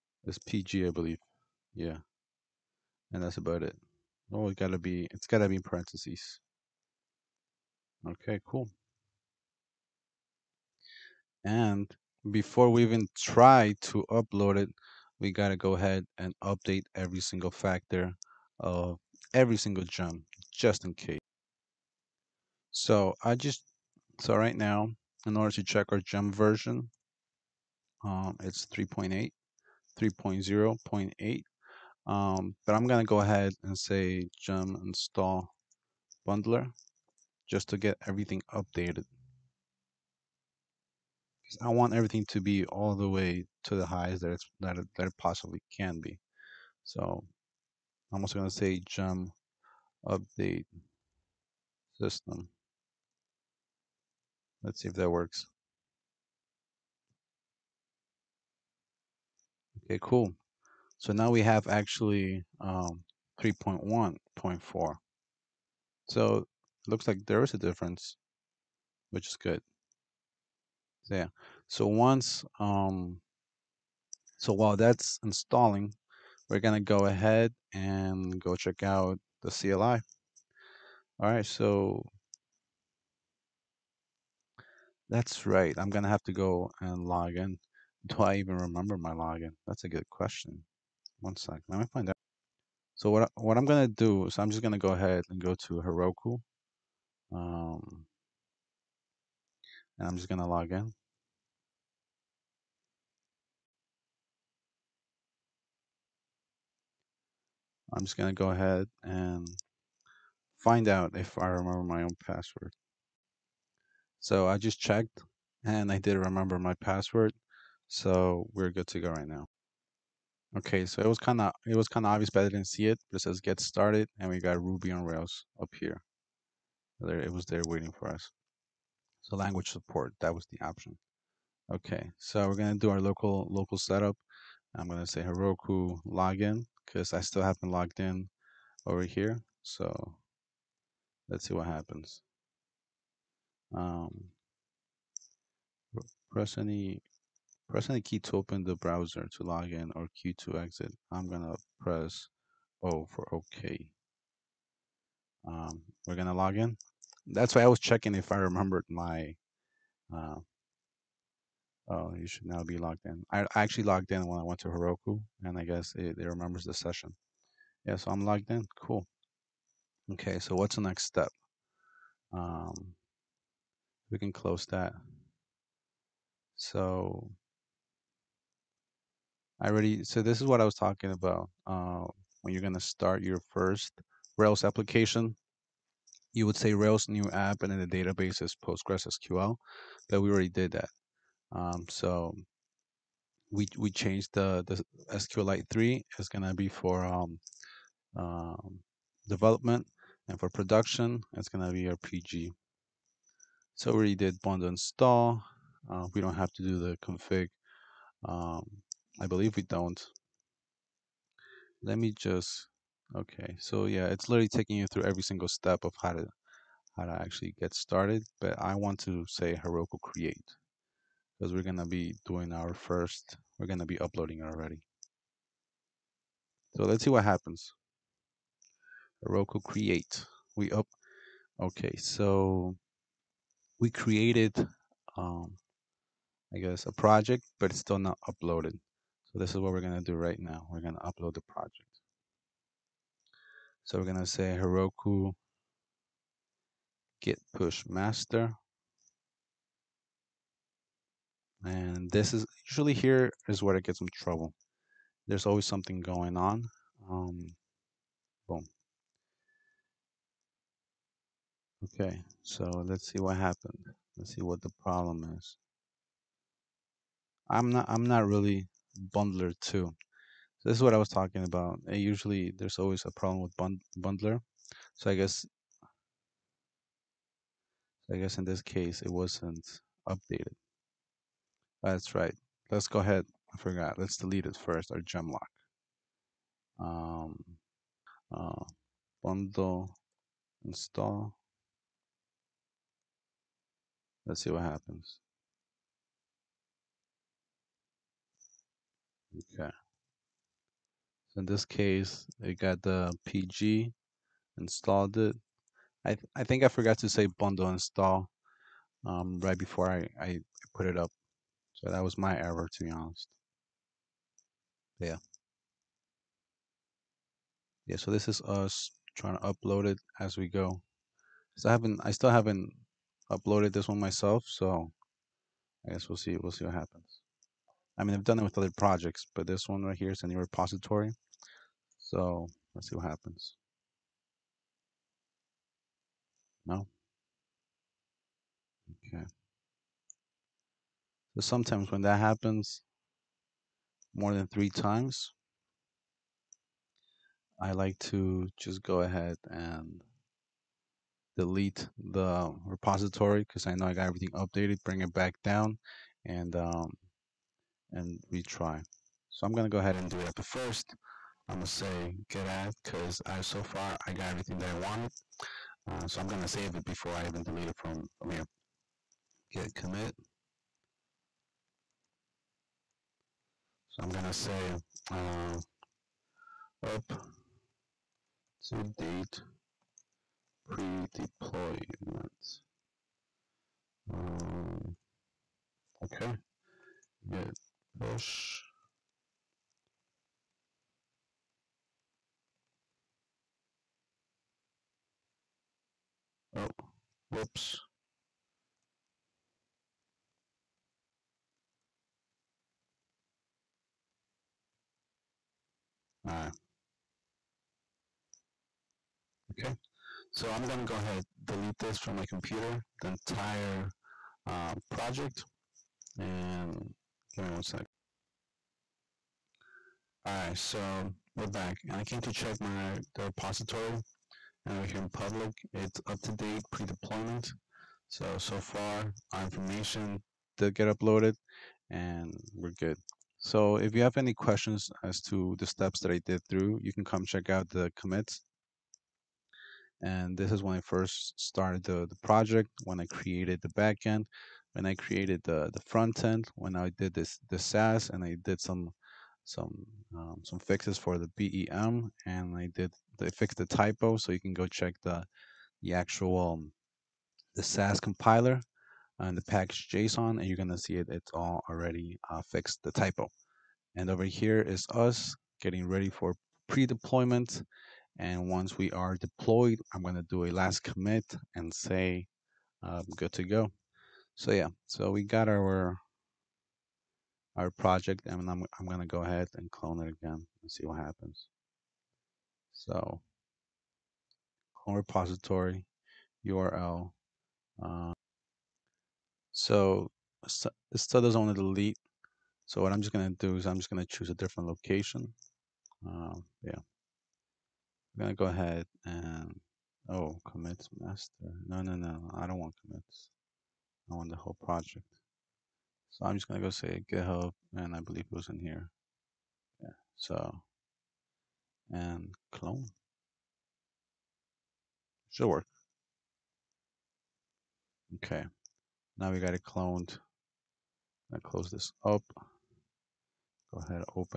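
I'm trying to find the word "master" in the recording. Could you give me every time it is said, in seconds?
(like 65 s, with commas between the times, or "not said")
247 s, 500 s.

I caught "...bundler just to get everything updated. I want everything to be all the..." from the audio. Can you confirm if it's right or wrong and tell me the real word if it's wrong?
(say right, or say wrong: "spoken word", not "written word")
right.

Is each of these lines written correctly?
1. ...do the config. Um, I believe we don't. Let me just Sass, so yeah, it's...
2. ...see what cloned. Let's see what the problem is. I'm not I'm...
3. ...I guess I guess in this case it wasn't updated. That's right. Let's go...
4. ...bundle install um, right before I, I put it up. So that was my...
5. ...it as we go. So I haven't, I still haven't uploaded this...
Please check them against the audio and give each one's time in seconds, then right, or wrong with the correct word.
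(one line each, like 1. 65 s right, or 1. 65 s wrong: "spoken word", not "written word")
1. 206 s wrong: "Okay", not "Sass"
2. 263 s wrong: "happened", not "cloned"
3. 275 s right
4. 307 s right
5. 319 s right.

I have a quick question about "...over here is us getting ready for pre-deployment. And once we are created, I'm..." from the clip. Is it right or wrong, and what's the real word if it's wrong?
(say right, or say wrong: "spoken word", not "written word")
wrong: "deployed", not "created".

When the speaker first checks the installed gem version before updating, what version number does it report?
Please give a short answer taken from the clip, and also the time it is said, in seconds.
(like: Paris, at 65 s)
3.0.8, at 29 s.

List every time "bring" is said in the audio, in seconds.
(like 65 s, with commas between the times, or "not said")
354 s.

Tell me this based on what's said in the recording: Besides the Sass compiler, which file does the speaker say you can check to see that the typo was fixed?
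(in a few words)
package JSON.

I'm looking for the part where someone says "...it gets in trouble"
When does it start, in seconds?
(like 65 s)
253 s.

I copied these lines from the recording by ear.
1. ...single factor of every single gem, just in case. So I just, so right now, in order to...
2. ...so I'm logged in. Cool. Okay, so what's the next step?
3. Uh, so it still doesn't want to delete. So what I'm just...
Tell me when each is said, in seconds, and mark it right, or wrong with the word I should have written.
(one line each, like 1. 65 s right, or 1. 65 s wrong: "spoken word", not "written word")
1. 17 s right
2. 167 s right
3. 487 s right.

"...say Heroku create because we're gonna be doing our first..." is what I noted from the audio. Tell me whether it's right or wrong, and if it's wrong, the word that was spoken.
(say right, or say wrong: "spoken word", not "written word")
right.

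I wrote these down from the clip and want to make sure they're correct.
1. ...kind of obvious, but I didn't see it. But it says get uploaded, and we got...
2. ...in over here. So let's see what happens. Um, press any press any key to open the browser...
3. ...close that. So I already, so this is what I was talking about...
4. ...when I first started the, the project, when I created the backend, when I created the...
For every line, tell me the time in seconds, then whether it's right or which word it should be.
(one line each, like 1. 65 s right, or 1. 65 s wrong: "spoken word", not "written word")
1. 121 s wrong: "started", not "uploaded"
2. 138 s right
3. 174 s right
4. 440 s right.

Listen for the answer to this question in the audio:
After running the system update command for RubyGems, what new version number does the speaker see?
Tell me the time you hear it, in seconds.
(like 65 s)
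63 s.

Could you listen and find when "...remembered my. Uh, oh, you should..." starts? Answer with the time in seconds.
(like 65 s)
158 s.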